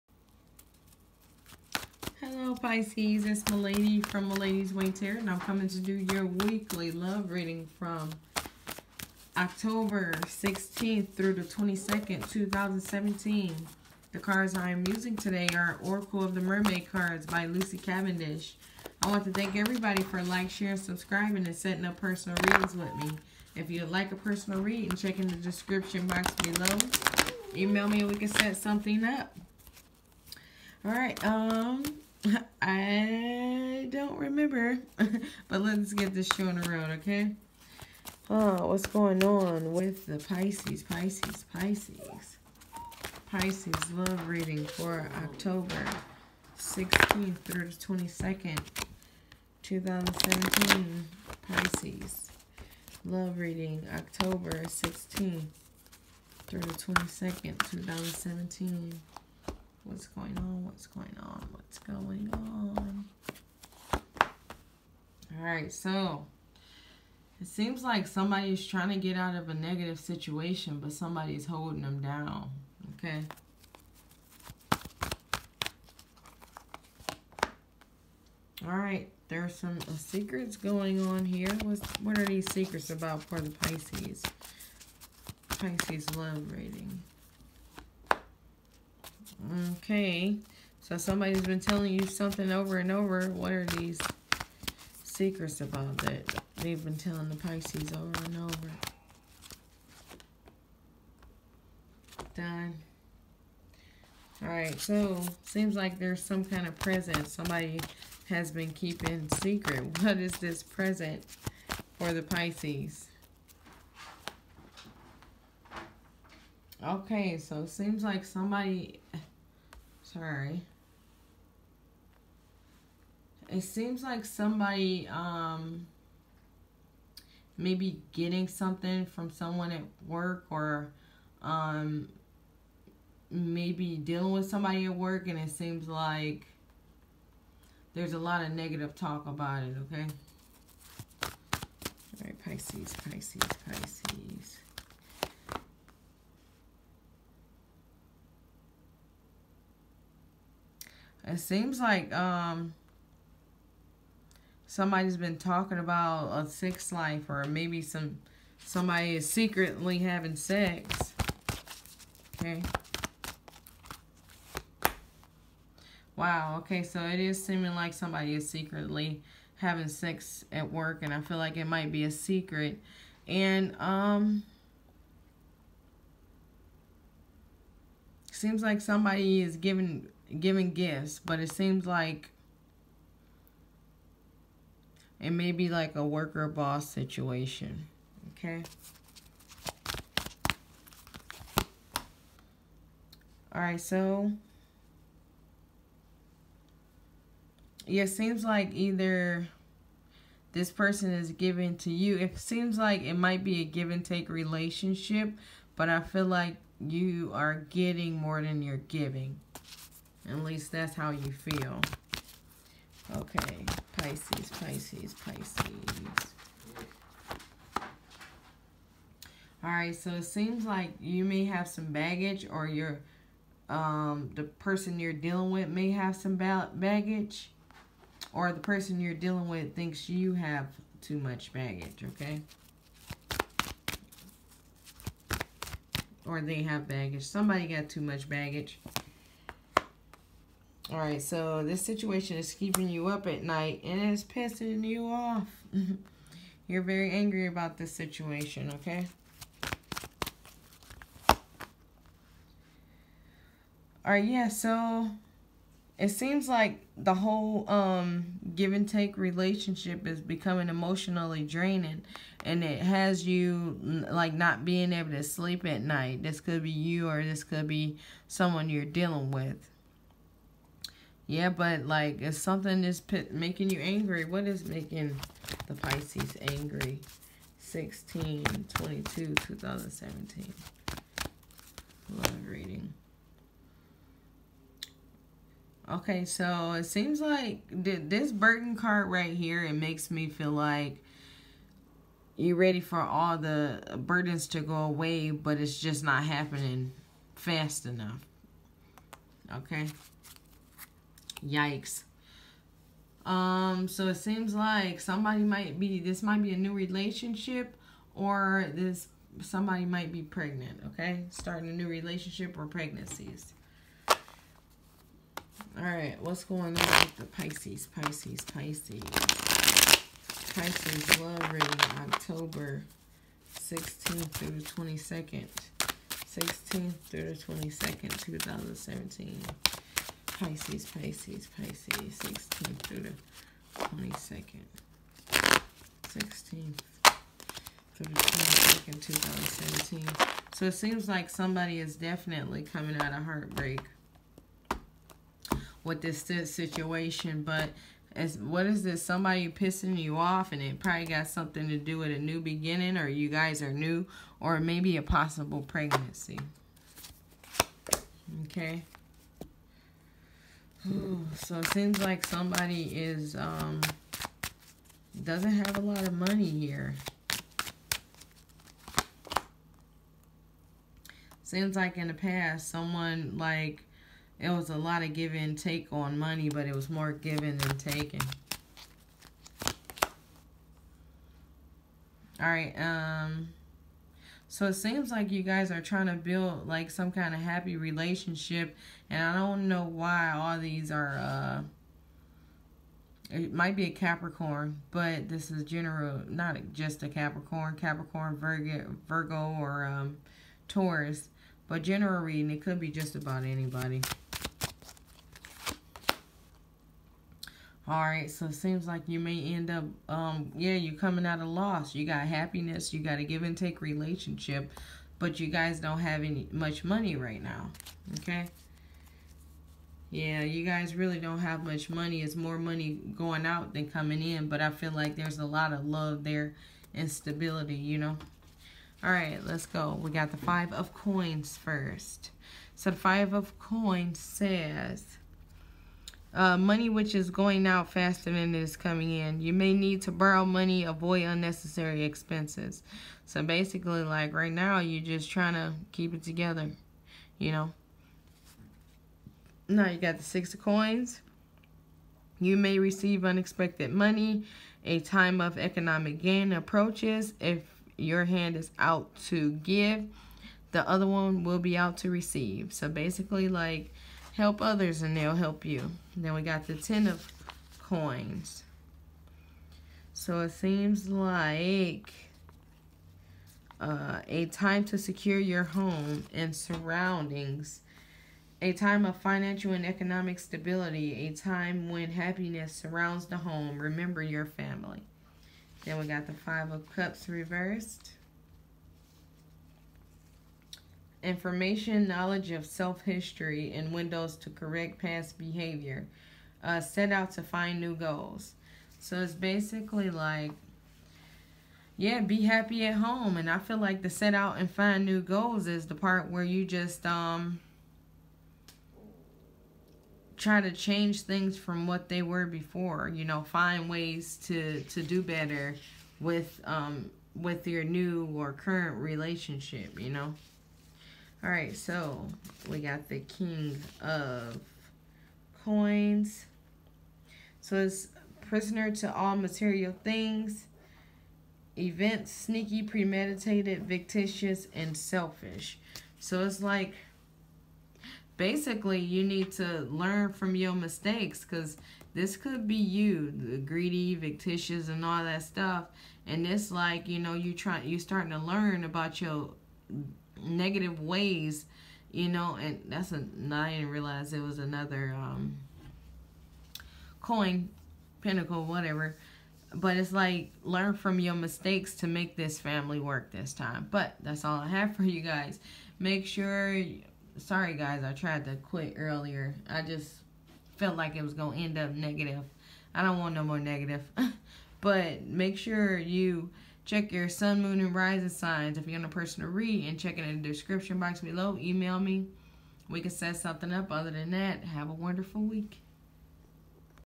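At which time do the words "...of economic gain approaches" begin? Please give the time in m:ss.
7:35.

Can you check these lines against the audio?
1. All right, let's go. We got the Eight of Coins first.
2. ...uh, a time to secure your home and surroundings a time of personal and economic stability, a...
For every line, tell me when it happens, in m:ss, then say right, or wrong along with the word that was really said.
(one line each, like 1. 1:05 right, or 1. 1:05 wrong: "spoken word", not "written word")
1. 7:09 wrong: "Five", not "Eight"
2. 7:53 wrong: "financial", not "personal".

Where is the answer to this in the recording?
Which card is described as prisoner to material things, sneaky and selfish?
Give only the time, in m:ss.
8:43.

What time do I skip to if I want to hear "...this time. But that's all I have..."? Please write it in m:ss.
9:23.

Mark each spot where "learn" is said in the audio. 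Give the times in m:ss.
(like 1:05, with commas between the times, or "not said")
8:59, 9:08, 9:20.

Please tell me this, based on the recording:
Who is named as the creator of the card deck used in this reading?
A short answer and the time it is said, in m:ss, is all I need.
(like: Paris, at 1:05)
Lucy Cavendish, at 0:17.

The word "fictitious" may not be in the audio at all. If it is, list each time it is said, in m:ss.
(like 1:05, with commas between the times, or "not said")
8:53, 9:04.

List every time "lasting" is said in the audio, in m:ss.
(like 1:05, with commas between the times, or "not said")
not said.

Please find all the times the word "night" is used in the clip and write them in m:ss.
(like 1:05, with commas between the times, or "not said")
4:03, 4:25.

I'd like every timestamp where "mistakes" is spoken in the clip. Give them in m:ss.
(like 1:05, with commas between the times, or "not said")
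9:00, 9:21.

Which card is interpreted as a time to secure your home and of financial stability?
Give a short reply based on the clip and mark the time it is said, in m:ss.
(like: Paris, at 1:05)
Ten of Coins, at 7:46.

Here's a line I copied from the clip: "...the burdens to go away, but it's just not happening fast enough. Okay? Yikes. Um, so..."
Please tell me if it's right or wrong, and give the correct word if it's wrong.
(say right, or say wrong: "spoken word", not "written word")
right.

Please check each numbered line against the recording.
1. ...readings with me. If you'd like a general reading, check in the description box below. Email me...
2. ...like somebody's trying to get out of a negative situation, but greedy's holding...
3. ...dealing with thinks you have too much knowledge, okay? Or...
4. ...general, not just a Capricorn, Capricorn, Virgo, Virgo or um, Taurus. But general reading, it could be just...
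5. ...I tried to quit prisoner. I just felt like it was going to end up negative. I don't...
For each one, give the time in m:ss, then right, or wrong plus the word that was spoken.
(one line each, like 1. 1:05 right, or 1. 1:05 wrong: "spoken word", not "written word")
1. 0:22 wrong: "personal", not "general"
2. 1:07 wrong: "somebody", not "greedy"
3. 3:49 wrong: "baggage", not "knowledge"
4. 6:35 right
5. 9:28 wrong: "earlier", not "prisoner".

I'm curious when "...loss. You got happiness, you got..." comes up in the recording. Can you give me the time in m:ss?
6:51.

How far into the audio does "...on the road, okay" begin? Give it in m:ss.
0:36.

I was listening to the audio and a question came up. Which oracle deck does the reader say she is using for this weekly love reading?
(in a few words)
Oracle of the Mermaid.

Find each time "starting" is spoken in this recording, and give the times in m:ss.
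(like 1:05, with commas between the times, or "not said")
5:11, 9:07.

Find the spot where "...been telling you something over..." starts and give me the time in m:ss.
1:31.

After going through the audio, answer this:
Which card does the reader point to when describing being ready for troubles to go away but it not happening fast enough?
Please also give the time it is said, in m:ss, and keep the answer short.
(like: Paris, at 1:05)
Burden card, at 4:48.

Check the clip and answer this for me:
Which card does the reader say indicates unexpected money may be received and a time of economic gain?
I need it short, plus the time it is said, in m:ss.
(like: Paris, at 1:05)
Six of Coins, at 7:30.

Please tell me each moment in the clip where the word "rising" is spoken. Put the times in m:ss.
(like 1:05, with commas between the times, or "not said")
9:37.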